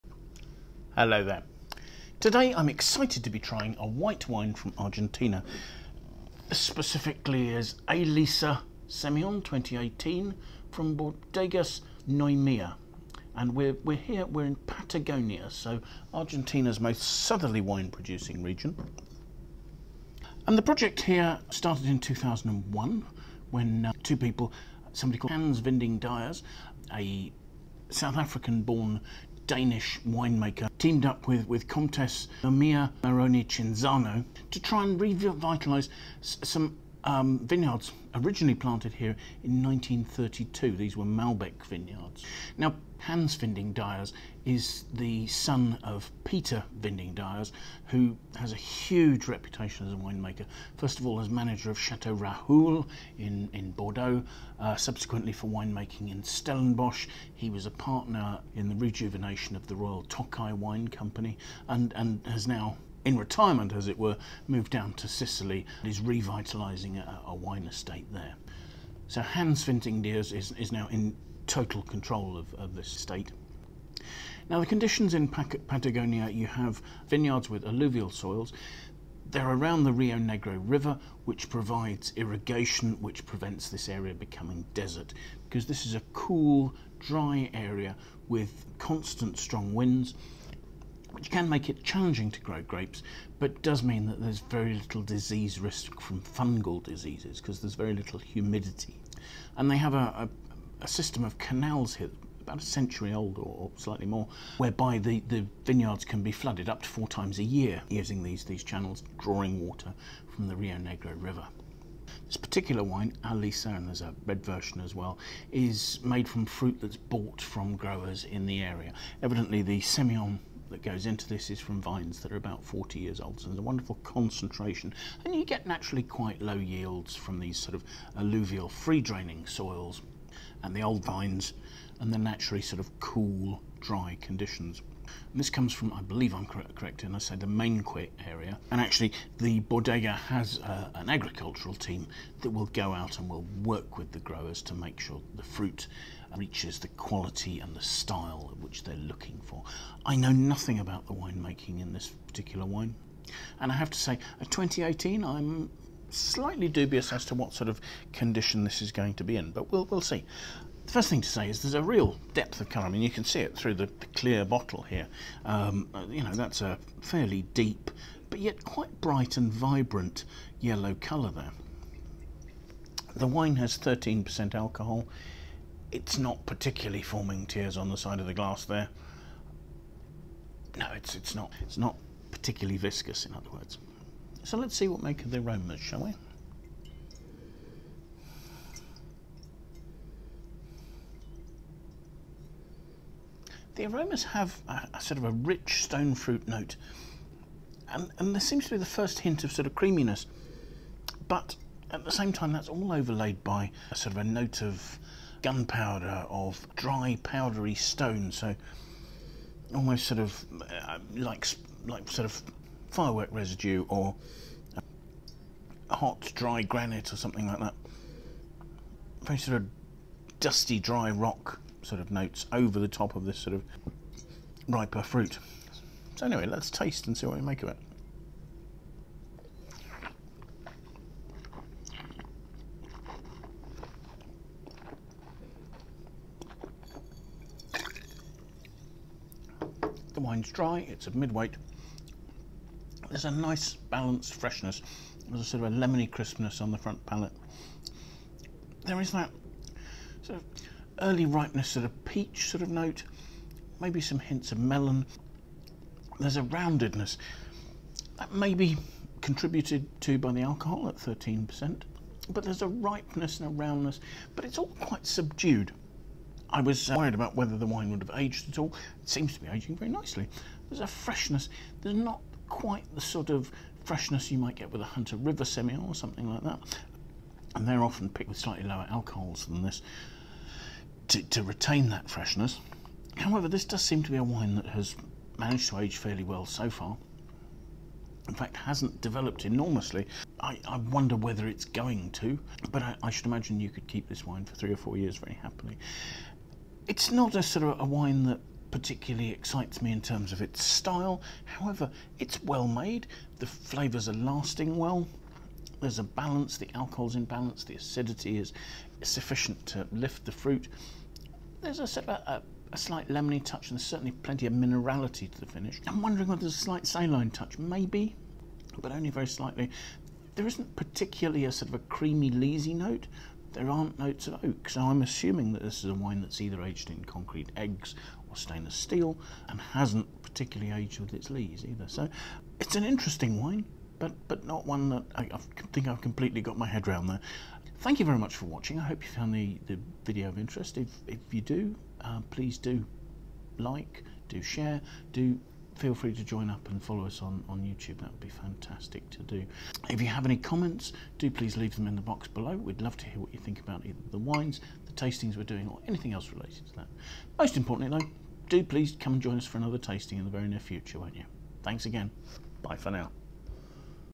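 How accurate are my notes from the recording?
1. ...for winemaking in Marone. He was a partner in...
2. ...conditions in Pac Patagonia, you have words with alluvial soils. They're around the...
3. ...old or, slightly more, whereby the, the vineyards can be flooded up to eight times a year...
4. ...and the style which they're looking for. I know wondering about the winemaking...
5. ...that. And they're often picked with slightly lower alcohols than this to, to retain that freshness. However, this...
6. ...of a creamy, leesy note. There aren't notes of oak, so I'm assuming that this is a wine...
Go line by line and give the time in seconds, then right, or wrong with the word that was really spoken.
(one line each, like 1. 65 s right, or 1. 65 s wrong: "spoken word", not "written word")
1. 55 s wrong: "Stellenbosch", not "Marone"
2. 74 s wrong: "vineyards", not "words"
3. 103 s wrong: "four", not "eight"
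4. 147 s wrong: "nothing", not "wondering"
5. 276 s right
6. 321 s right.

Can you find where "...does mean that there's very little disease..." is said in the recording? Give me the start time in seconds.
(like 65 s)
93 s.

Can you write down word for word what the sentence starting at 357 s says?
Most importantly, though, do please come and join us for another tasting in the very near future, won't you?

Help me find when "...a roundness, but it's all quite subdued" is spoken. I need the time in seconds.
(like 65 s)
263 s.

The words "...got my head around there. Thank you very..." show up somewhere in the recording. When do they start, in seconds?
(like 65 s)
336 s.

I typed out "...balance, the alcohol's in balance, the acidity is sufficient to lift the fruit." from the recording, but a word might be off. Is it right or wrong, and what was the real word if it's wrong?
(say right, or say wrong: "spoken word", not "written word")
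right.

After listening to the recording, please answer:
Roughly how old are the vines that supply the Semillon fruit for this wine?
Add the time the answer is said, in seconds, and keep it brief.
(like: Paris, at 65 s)
40 years, at 122 s.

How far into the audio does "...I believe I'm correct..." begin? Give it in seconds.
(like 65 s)
135 s.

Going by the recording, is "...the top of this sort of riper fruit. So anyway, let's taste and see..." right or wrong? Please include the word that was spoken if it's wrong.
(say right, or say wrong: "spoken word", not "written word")
right.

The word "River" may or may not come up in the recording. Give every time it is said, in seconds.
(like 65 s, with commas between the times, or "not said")
80 s, 111 s, 275 s.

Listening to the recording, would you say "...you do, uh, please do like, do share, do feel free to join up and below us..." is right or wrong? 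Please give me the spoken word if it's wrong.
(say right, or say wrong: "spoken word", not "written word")
wrong: "follow", not "below".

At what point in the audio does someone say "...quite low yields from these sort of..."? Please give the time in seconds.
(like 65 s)
126 s.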